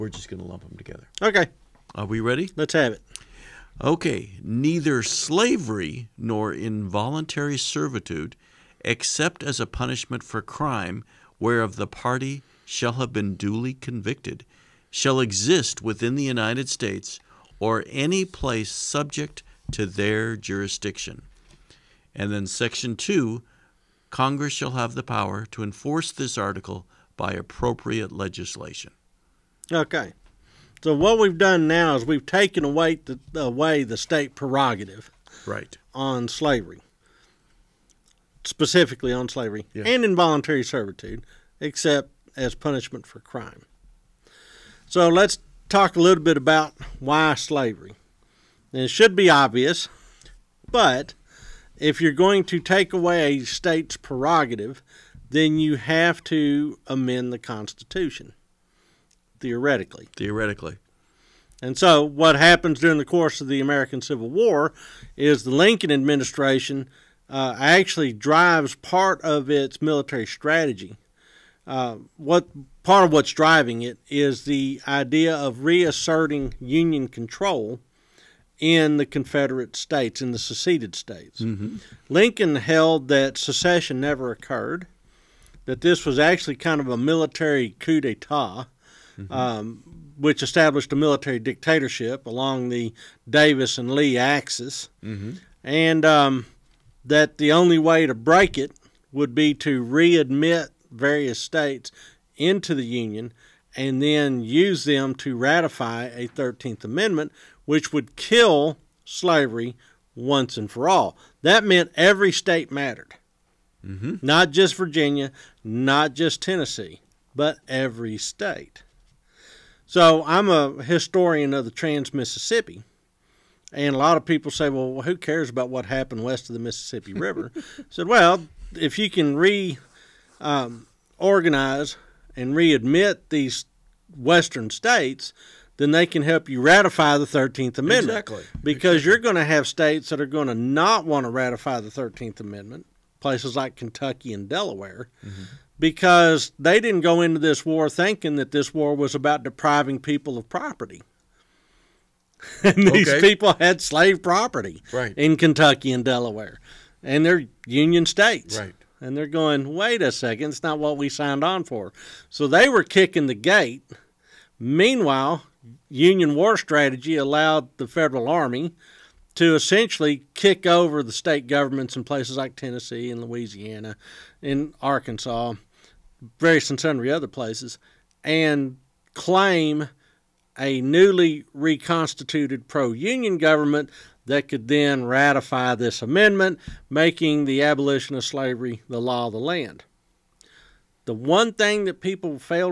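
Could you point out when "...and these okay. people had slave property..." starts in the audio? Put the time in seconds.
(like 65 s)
152 s.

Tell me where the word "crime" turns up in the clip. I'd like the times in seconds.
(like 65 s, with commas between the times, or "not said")
10 s, 43 s.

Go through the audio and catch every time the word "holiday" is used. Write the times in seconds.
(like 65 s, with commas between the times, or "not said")
not said.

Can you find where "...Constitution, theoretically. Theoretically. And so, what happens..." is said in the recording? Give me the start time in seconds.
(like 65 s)
57 s.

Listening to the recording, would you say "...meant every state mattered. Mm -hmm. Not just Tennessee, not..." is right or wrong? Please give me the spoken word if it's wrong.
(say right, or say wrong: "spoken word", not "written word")
wrong: "Virginia", not "Tennessee".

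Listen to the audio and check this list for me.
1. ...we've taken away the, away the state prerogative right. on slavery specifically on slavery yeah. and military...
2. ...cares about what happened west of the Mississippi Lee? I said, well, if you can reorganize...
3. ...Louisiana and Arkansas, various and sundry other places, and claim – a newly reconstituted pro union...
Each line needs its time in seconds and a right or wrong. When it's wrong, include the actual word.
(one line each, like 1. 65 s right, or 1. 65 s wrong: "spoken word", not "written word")
1. 32 s wrong: "involuntary", not "military"
2. 125 s wrong: "River", not "Lee"
3. 173 s right.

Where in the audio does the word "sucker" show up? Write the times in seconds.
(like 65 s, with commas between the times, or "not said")
not said.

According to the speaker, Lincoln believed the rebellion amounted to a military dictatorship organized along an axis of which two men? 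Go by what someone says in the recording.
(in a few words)
Davis and Lee.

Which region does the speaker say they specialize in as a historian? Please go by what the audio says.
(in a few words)
Trans Mississippi.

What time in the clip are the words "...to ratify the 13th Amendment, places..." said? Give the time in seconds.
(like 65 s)
141 s.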